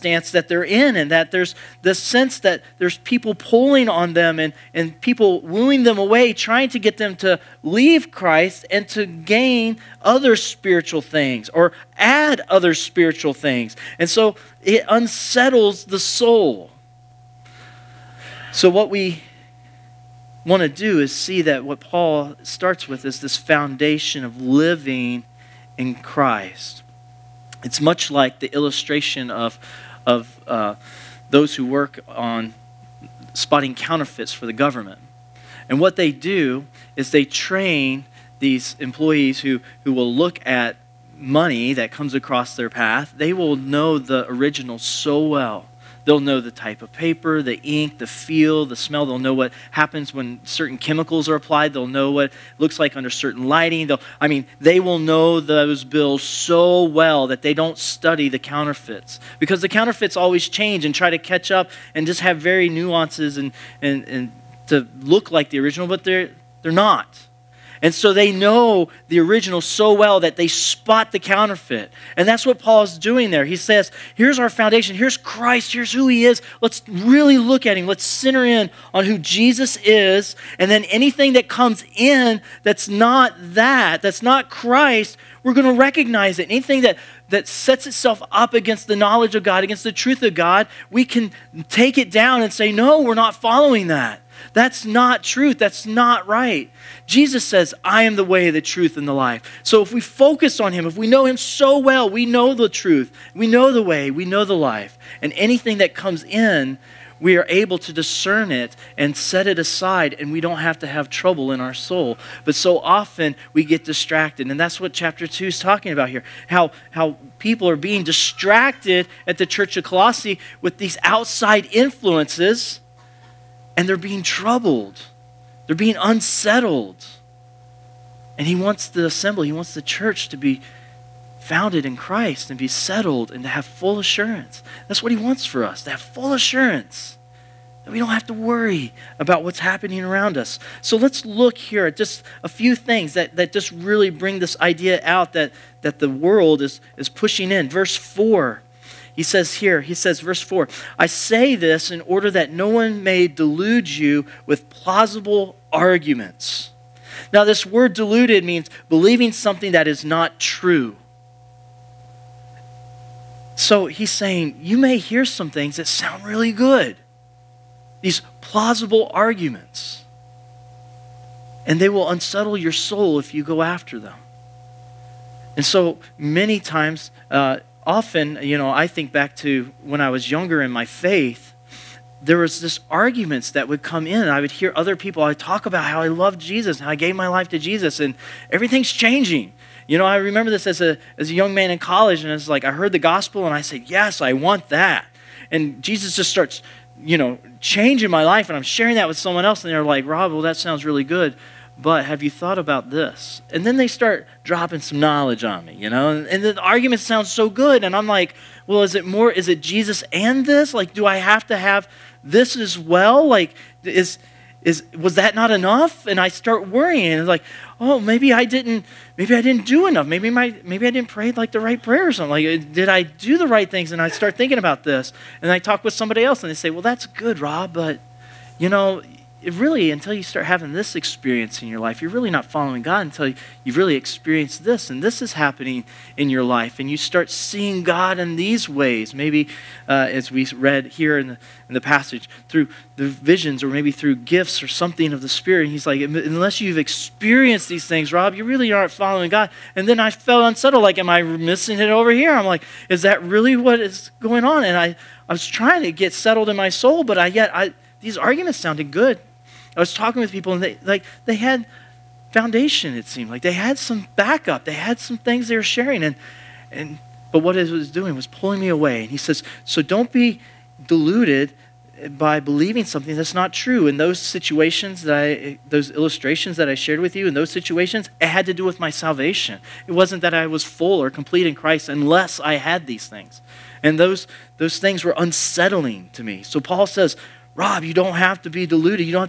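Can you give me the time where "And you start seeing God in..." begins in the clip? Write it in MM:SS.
03:56.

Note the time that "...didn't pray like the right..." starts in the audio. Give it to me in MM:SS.
03:40.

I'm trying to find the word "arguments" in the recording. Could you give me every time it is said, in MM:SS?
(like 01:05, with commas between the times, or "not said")
02:35, 02:49, 03:02, 03:26, 04:18.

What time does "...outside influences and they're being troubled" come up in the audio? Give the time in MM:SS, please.
02:01.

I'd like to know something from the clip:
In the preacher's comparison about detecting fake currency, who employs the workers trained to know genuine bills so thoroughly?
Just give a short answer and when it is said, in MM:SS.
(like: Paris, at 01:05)
The government, at 00:34.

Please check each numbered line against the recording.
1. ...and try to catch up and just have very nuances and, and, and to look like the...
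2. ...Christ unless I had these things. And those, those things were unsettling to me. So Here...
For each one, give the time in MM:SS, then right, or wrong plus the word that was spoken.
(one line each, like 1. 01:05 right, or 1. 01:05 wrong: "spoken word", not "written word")
1. 01:00 right
2. 04:41 wrong: "Paul", not "Here".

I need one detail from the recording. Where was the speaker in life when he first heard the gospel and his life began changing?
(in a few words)
In college.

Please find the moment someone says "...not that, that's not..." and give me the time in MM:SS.
01:22.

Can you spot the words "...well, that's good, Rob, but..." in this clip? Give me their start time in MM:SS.
03:46.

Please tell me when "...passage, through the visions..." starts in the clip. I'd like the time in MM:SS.
04:01.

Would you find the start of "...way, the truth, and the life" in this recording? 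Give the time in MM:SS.
01:38.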